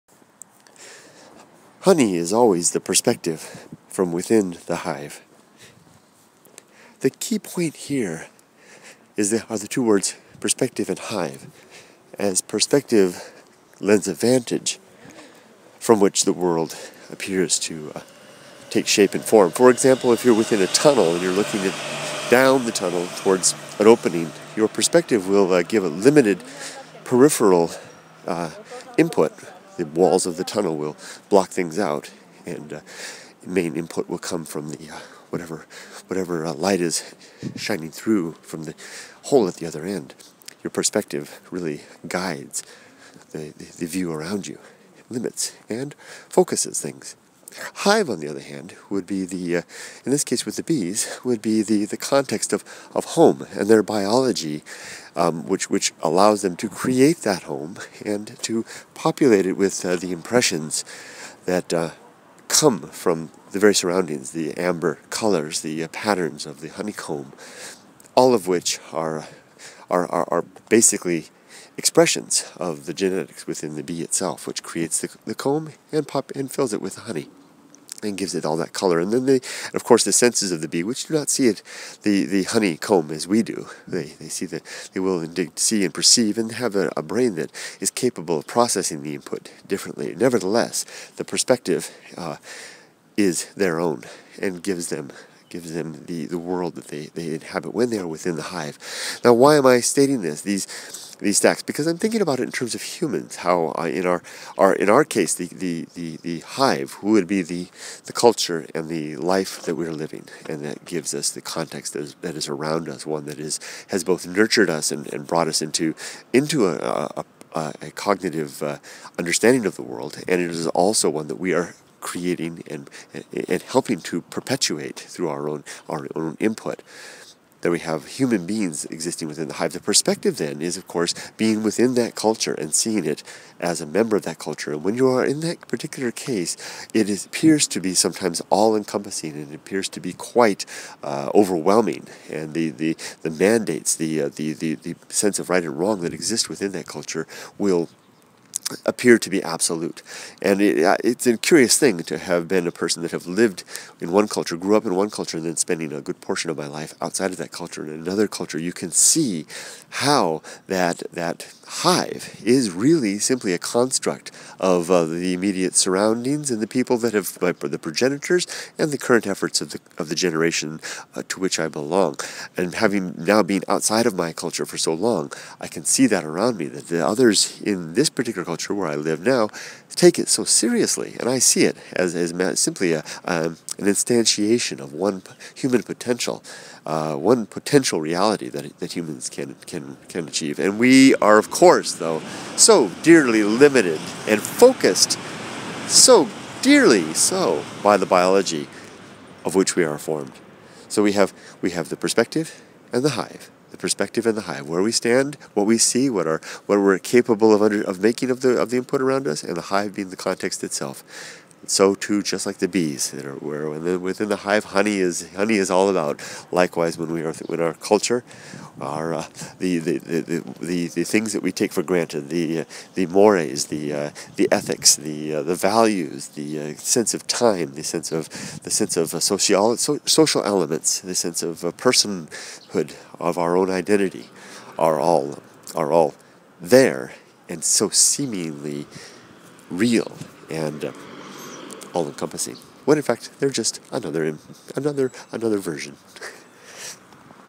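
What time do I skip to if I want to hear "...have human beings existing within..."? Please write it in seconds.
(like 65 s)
127 s.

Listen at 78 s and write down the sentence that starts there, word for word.
And then they, and of course, the senses of the bee, which do not see it, the, the honeycomb as we do.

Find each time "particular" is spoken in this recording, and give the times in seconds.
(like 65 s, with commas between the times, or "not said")
135 s, 178 s.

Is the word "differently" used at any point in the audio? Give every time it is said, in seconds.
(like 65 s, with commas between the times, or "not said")
89 s.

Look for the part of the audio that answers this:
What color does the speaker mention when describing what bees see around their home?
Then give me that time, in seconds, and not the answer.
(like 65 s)
64 s.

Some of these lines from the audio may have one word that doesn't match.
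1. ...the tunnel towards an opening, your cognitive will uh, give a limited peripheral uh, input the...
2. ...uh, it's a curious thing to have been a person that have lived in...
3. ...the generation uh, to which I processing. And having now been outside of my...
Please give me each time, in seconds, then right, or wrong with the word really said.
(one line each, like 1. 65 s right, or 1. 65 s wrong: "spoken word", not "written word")
1. 22 s wrong: "perspective", not "cognitive"
2. 150 s right
3. 170 s wrong: "belong", not "processing".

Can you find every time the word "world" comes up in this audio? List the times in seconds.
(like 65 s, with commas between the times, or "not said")
16 s, 96 s, 119 s.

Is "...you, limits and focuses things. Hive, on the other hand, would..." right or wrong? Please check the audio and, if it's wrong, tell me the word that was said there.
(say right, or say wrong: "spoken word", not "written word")
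right.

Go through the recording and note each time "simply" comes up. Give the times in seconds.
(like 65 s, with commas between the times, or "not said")
163 s, 182 s.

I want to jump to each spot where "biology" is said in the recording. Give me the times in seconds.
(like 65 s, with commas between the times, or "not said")
53 s, 198 s.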